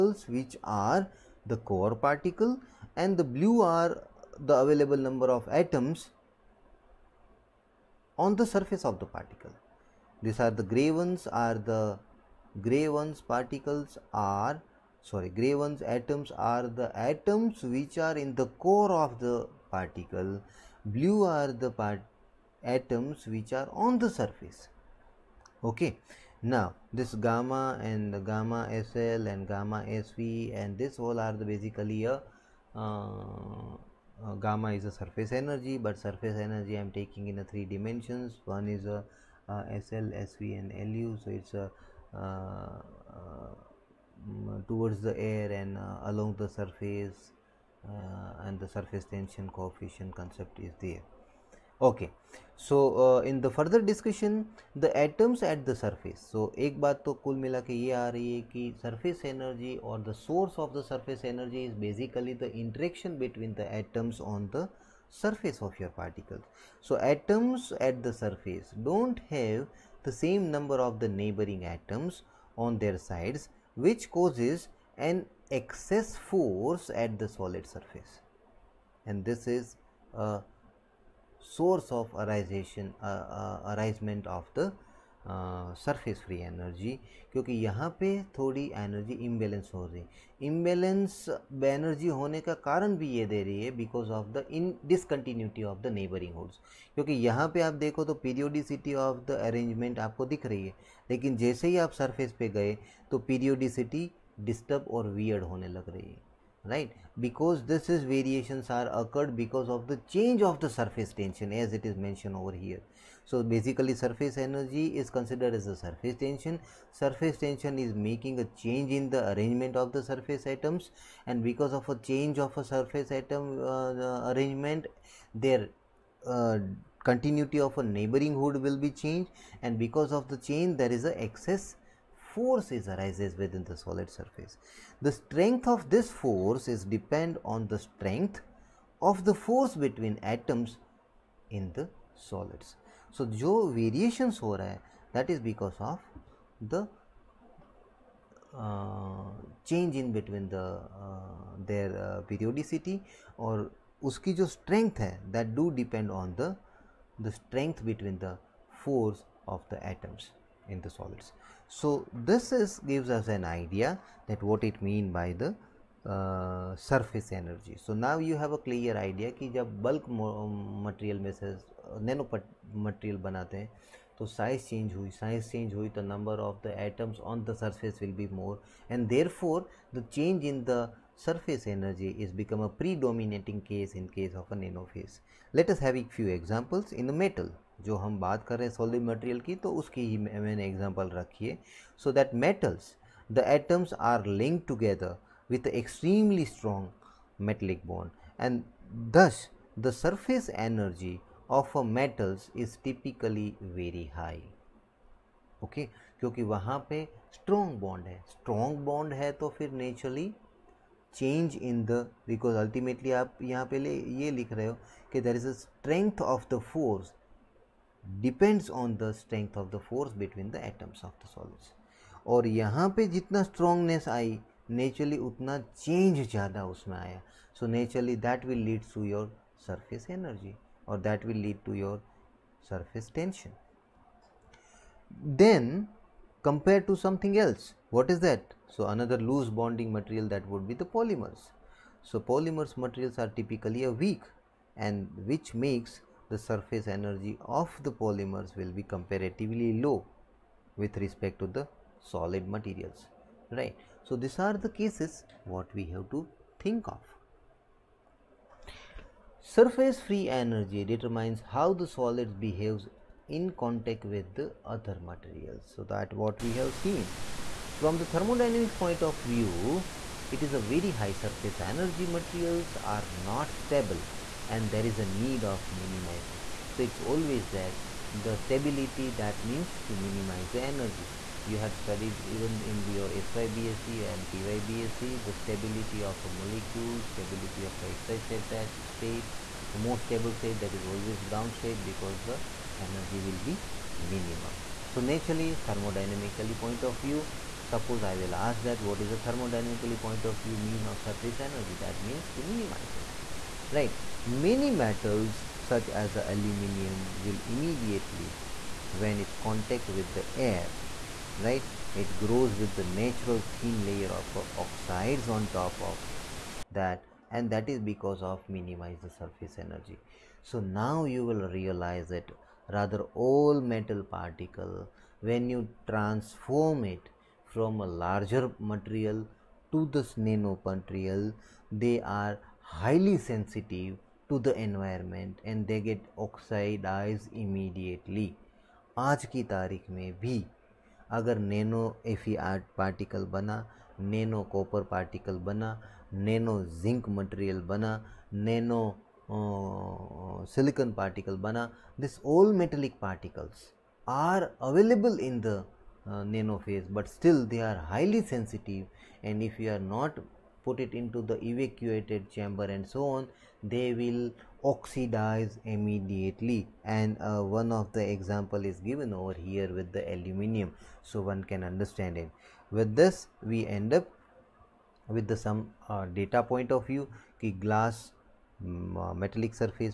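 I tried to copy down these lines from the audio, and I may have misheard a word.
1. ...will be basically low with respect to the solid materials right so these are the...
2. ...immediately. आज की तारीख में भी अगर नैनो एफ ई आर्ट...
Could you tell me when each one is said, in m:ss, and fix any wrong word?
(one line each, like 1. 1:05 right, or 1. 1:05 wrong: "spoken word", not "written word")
1. 4:08 wrong: "comparatively", not "basically"
2. 5:37 right.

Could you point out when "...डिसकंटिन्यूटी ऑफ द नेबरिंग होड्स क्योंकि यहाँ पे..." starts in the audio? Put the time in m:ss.
1:34.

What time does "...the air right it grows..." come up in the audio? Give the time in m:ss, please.
5:10.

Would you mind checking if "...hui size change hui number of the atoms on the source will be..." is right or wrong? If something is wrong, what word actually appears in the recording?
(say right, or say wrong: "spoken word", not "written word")
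wrong: "surface", not "source".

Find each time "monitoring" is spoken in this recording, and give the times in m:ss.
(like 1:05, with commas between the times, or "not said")
not said.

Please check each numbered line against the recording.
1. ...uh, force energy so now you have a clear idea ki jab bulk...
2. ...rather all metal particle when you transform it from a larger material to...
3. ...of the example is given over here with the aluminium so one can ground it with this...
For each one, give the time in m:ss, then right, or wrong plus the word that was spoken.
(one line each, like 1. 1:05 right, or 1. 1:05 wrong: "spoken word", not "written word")
1. 2:46 wrong: "surface", not "force"
2. 5:22 right
3. 6:07 wrong: "understand", not "ground".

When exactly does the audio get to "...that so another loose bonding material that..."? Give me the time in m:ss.
3:58.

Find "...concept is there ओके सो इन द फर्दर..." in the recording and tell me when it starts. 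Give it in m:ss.
0:50.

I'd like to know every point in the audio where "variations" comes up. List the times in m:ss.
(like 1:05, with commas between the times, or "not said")
1:48, 2:23.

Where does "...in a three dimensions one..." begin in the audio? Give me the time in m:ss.
0:37.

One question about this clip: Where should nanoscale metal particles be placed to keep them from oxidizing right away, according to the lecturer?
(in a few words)
Evacuated chamber.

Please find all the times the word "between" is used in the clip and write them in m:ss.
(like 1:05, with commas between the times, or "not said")
2:19, 2:30, 2:37, 3:40.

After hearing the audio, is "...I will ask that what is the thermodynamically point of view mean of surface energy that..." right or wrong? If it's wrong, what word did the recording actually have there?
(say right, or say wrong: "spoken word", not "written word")
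right.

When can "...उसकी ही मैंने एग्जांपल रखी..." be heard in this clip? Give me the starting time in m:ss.
3:09.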